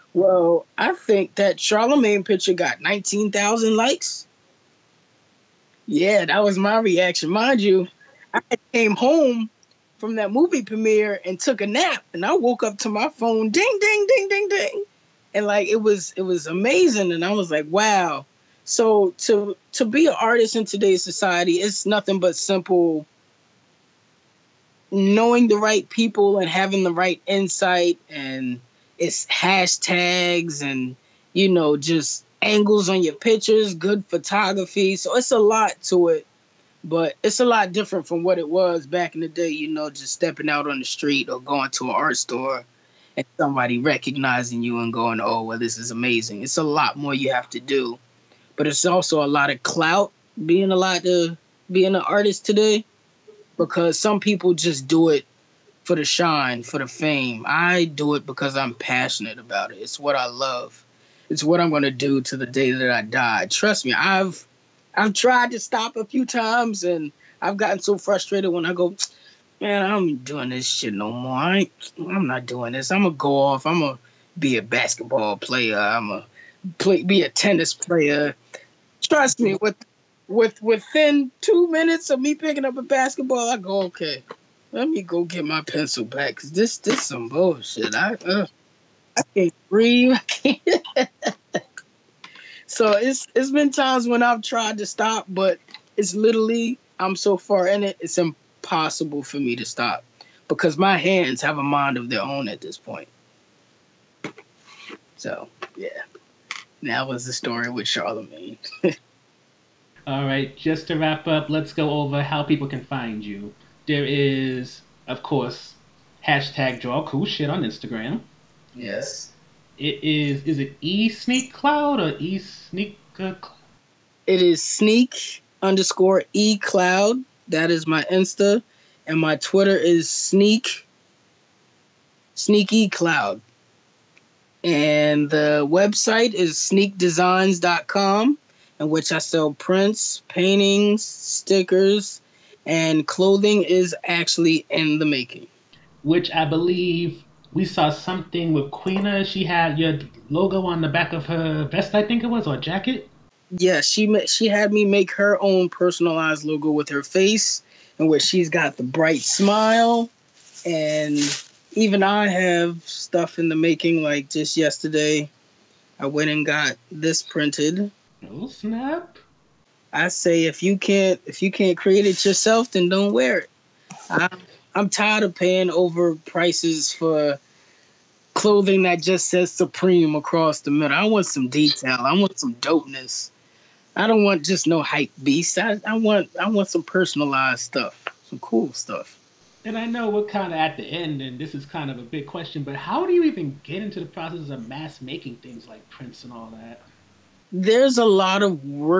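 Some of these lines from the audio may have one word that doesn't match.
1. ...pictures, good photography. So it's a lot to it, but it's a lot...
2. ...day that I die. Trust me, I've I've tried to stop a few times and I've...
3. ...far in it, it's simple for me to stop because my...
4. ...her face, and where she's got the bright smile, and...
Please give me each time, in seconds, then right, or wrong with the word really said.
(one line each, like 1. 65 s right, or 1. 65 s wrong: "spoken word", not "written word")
1. 33 s right
2. 62 s right
3. 97 s wrong: "impossible", not "simple"
4. 156 s right.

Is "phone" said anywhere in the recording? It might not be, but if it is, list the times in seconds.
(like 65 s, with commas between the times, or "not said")
13 s.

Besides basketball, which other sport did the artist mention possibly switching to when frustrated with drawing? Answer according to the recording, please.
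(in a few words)
tennis.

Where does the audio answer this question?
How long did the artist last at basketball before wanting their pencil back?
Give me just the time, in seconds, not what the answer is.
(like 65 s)
81 s.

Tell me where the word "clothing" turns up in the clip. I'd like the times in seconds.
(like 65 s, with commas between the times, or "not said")
143 s, 178 s.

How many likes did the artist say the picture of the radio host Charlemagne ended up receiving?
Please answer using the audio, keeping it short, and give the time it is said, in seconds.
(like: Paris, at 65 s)
19,000, at 2 s.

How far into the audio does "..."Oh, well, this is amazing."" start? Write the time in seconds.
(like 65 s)
45 s.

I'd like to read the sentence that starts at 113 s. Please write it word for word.
There is, of course, hashtag draw cool shit on Instagram.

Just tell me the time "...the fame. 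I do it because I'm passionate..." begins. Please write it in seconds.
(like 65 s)
56 s.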